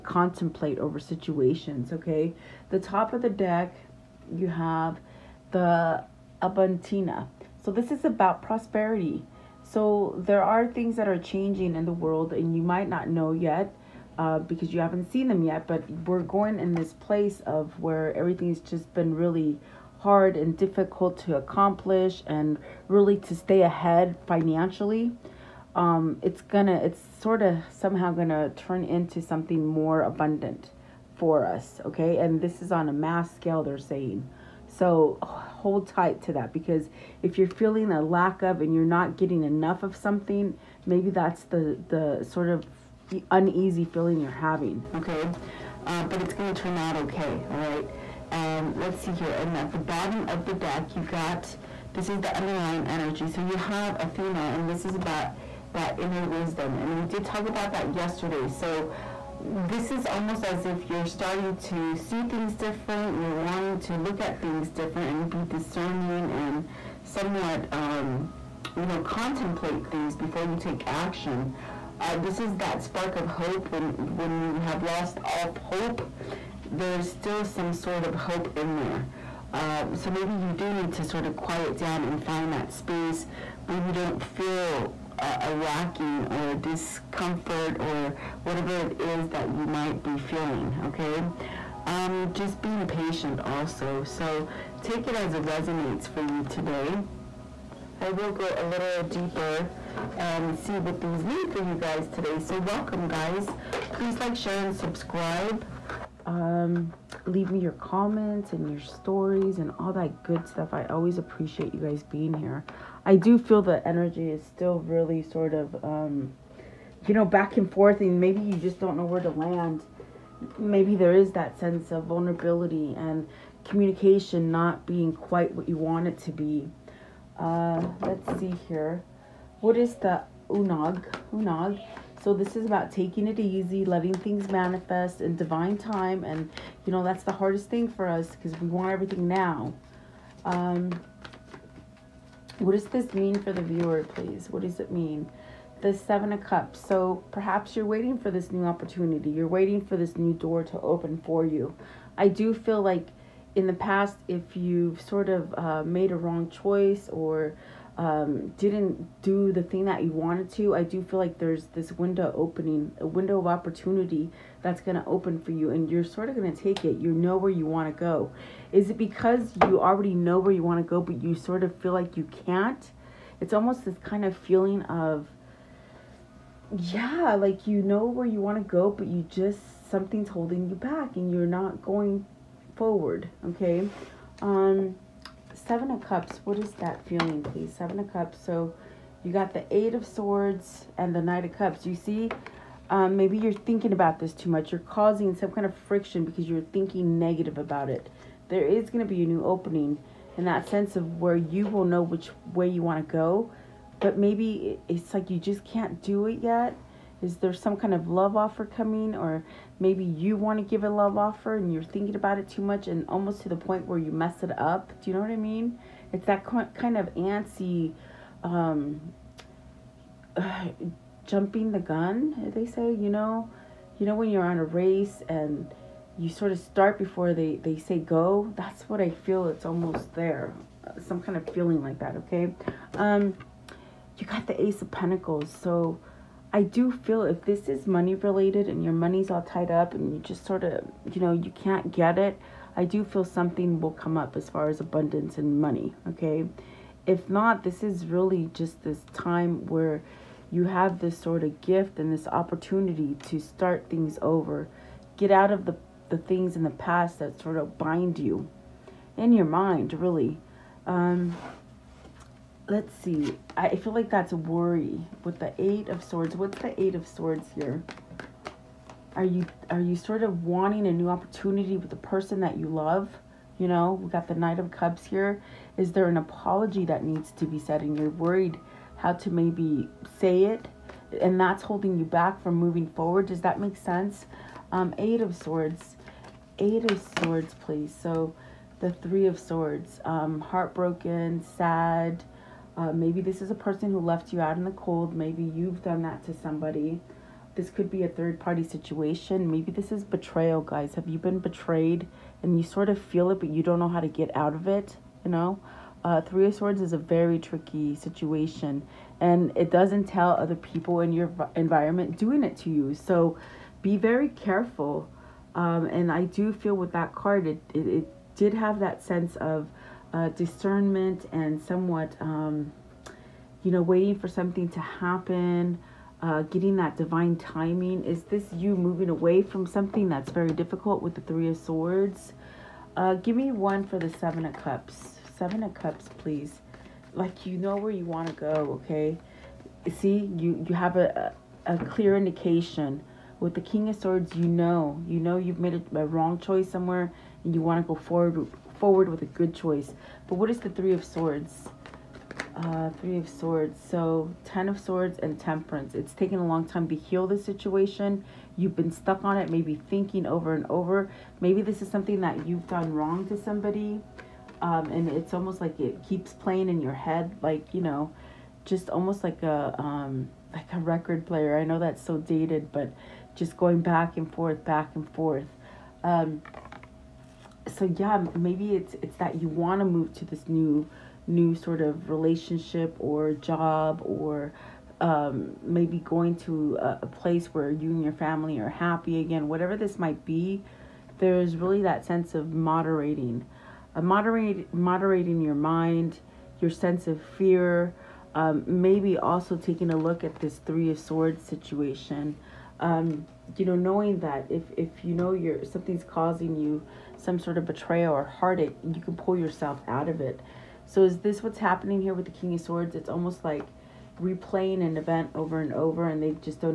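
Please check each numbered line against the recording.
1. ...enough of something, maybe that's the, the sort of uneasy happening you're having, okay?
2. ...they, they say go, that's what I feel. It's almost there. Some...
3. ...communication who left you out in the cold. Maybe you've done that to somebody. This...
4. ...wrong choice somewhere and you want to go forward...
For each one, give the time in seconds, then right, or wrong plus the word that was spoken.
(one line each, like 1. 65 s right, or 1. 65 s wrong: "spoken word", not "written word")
1. 39 s wrong: "feeling", not "happening"
2. 227 s right
3. 293 s wrong: "person", not "communication"
4. 346 s right.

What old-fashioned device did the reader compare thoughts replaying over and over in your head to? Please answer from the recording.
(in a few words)
record player.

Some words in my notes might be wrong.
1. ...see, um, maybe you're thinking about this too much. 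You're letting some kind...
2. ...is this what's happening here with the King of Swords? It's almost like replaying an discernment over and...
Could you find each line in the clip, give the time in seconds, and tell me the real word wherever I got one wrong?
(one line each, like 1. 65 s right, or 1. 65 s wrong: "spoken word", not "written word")
1. 191 s wrong: "causing", not "letting"
2. 411 s wrong: "event", not "discernment".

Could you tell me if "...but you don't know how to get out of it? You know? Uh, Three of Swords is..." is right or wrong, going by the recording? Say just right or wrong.
right.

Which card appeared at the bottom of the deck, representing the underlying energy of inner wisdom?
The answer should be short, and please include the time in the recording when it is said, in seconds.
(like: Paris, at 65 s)
Athena, at 54 s.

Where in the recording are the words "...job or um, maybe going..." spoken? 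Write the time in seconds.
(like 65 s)
383 s.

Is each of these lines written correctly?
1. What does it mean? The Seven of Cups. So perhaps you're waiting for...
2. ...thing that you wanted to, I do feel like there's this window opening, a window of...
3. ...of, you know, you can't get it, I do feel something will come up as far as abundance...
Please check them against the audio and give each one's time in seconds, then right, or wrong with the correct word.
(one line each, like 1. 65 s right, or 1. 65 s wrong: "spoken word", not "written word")
1. 144 s right
2. 159 s right
3. 240 s right.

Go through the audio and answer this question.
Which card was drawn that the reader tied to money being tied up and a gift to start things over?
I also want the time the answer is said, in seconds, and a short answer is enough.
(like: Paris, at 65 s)
Ace of Pentacles, at 234 s.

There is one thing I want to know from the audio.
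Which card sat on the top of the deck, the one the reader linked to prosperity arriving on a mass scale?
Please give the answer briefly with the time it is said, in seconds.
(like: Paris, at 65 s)
Abundantia, at 6 s.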